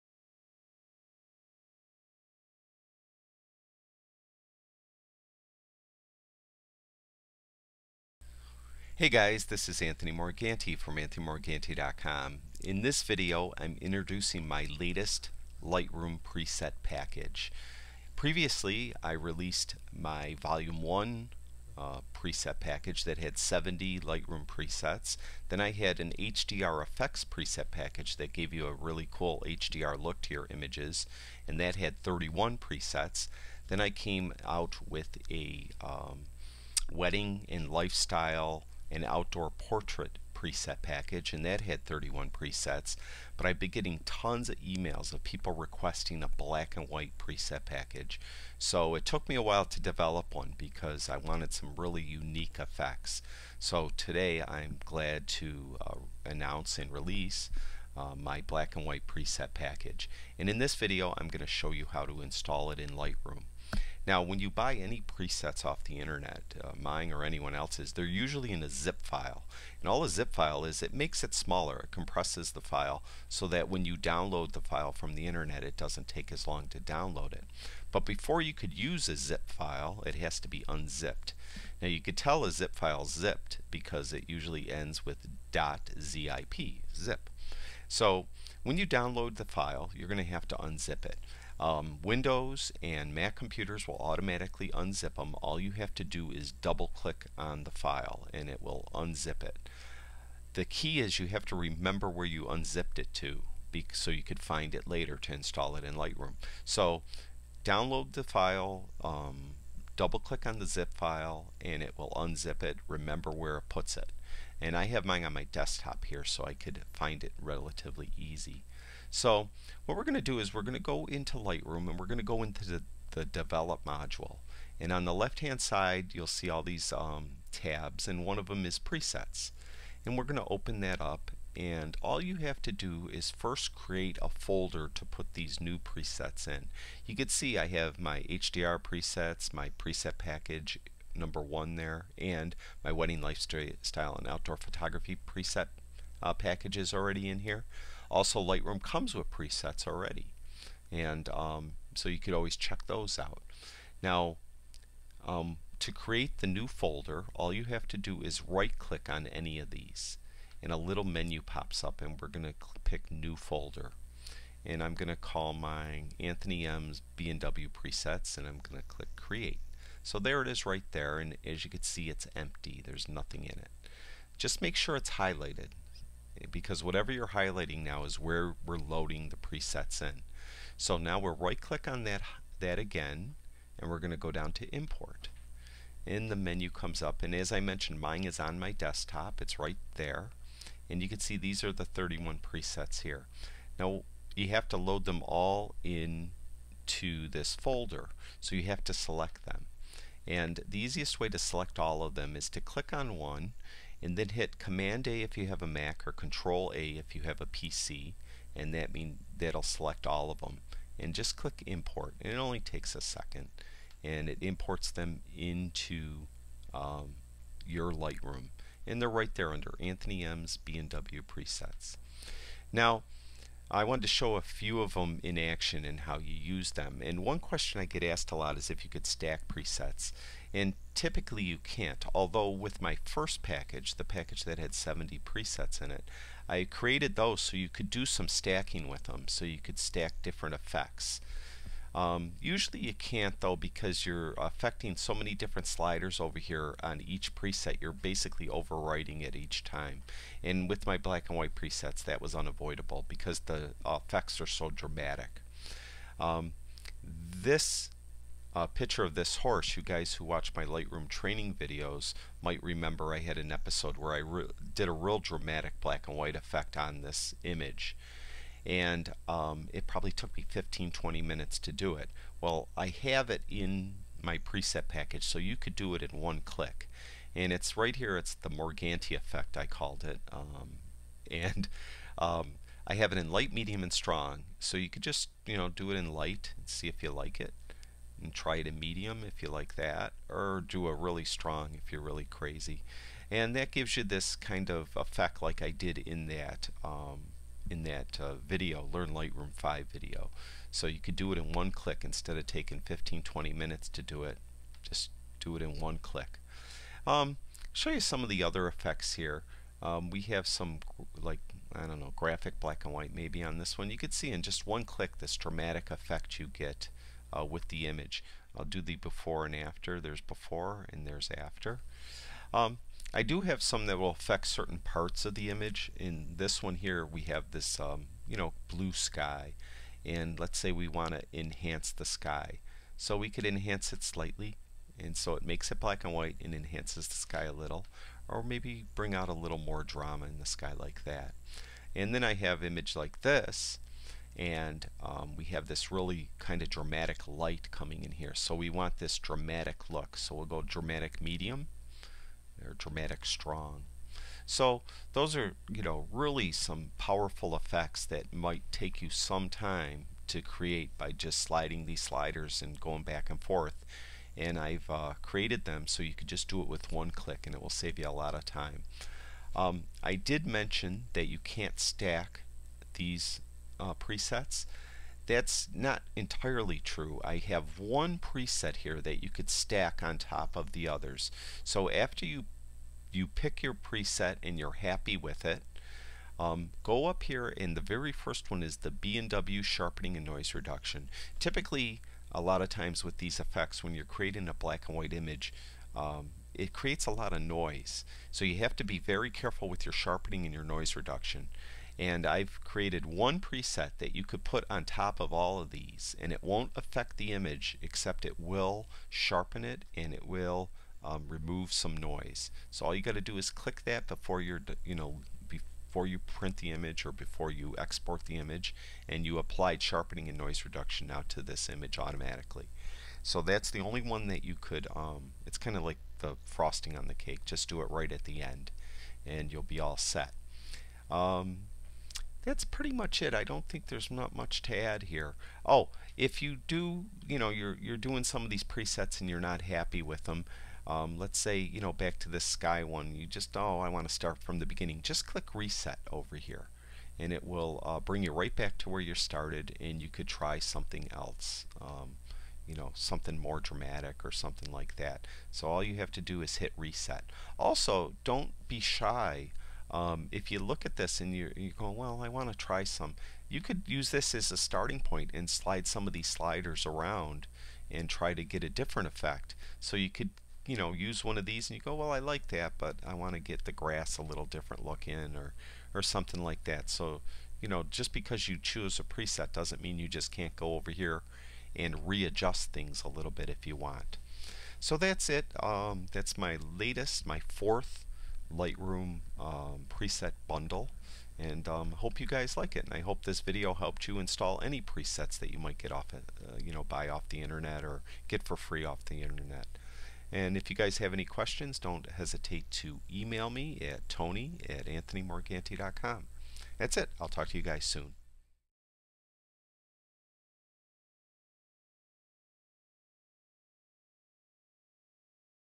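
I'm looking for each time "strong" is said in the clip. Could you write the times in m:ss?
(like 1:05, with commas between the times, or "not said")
4:43, 4:51, 5:53.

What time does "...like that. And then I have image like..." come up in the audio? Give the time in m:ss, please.
5:40.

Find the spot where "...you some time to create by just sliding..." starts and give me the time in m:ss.
5:59.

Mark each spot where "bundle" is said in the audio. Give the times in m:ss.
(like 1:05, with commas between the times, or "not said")
8:10.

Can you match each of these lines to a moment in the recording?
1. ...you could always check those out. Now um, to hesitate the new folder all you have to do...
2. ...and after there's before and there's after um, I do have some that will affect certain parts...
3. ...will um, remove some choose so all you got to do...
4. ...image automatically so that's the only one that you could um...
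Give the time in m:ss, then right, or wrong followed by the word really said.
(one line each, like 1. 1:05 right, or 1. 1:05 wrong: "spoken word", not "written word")
1. 2:32 wrong: "create", not "hesitate"
2. 5:19 right
3. 6:50 wrong: "noise", not "choose"
4. 7:01 right.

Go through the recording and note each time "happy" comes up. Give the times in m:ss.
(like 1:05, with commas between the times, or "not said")
6:24, 7:19.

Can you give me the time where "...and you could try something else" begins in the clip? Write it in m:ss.
7:29.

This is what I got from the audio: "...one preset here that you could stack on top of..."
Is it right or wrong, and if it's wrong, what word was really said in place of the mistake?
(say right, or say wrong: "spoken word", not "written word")
right.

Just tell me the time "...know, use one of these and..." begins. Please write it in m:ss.
7:50.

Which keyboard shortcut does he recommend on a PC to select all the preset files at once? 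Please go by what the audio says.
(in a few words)
Control A.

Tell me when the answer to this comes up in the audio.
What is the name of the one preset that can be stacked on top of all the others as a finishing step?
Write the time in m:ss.
6:28.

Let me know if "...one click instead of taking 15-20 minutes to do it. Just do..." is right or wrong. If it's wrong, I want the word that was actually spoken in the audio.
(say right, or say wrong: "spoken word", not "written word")
right.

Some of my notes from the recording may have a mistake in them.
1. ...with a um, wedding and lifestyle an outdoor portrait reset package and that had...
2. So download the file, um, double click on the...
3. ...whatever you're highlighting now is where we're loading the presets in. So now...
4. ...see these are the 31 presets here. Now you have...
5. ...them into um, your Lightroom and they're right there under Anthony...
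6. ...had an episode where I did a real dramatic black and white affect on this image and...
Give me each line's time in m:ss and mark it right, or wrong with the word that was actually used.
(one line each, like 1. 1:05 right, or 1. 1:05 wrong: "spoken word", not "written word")
1. 0:34 wrong: "preset", not "reset"
2. 1:46 right
3. 2:56 right
4. 3:11 right
5. 3:34 right
6. 4:23 wrong: "effect", not "affect".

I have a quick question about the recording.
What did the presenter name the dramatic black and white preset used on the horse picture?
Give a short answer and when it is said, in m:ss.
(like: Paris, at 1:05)
The Morganti effect, at 4:38.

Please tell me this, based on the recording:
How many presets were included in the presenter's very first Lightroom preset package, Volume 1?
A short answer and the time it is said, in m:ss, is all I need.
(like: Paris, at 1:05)
70, at 0:23.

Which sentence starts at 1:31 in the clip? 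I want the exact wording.
Um, Windows and Mac computers will automatically unzip them.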